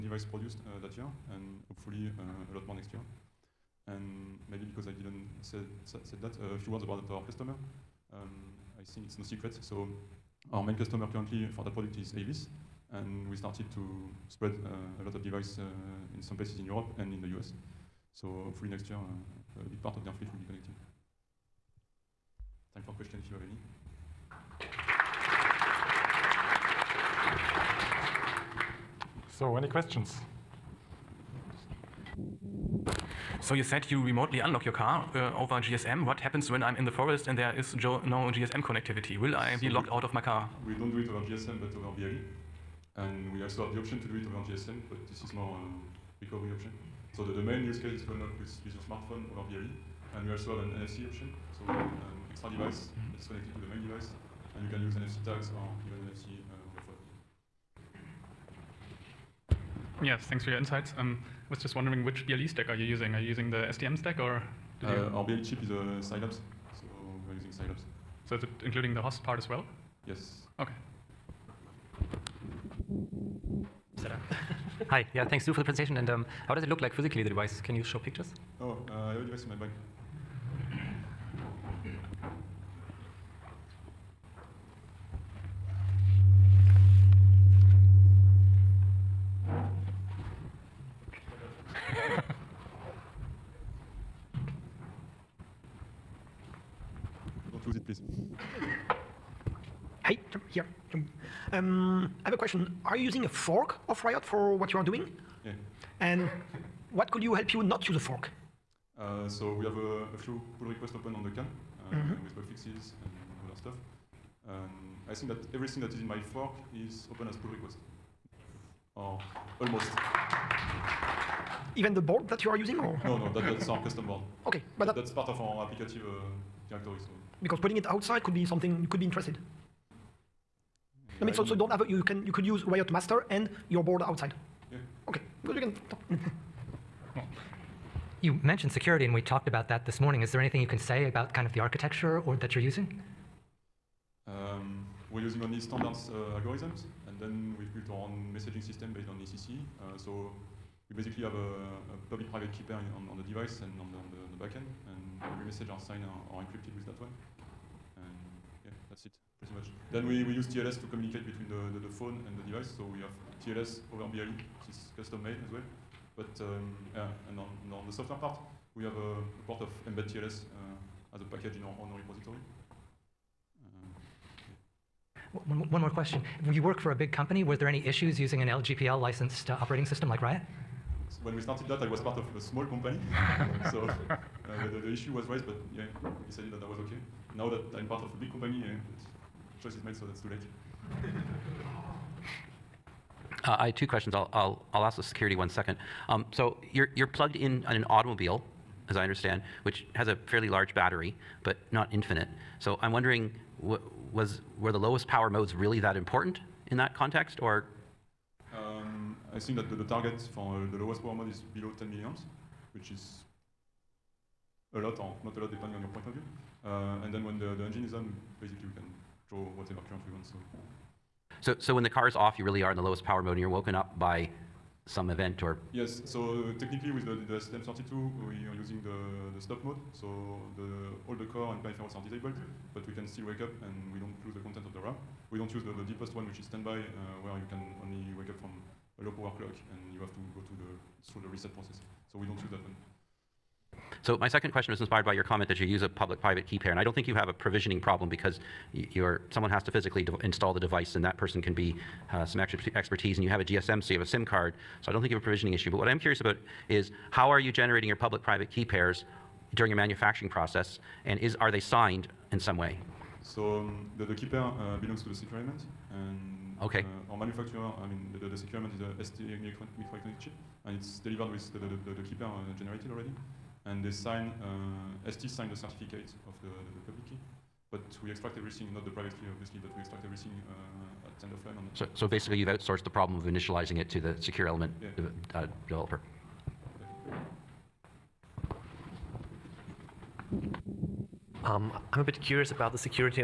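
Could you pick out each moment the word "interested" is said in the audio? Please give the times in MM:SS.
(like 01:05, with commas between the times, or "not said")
02:09.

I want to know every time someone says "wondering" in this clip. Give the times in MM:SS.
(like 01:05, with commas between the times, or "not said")
01:01, 03:22.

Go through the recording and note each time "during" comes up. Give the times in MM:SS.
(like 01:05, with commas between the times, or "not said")
04:19.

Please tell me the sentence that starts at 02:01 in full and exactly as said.
Even the board that you are using?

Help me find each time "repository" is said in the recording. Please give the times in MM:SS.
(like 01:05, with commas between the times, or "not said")
02:51.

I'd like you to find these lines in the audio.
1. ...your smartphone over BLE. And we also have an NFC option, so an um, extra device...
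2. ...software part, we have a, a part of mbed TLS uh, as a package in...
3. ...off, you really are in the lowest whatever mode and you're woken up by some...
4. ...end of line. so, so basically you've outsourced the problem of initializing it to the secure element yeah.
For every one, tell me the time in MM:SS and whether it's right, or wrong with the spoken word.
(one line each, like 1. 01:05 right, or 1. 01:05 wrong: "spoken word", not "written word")
1. 00:48 right
2. 02:47 right
3. 03:42 wrong: "power", not "whatever"
4. 04:41 right.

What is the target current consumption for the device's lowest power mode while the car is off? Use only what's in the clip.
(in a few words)
below 10 milliamps.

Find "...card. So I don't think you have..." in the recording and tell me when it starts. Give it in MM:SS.
04:14.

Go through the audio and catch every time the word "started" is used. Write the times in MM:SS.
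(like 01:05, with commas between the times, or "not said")
00:13, 03:01.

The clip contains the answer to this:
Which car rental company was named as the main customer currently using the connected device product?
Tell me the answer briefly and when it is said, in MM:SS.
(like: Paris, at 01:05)
Avis, at 00:12.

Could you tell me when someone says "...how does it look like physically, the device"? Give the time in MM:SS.
01:16.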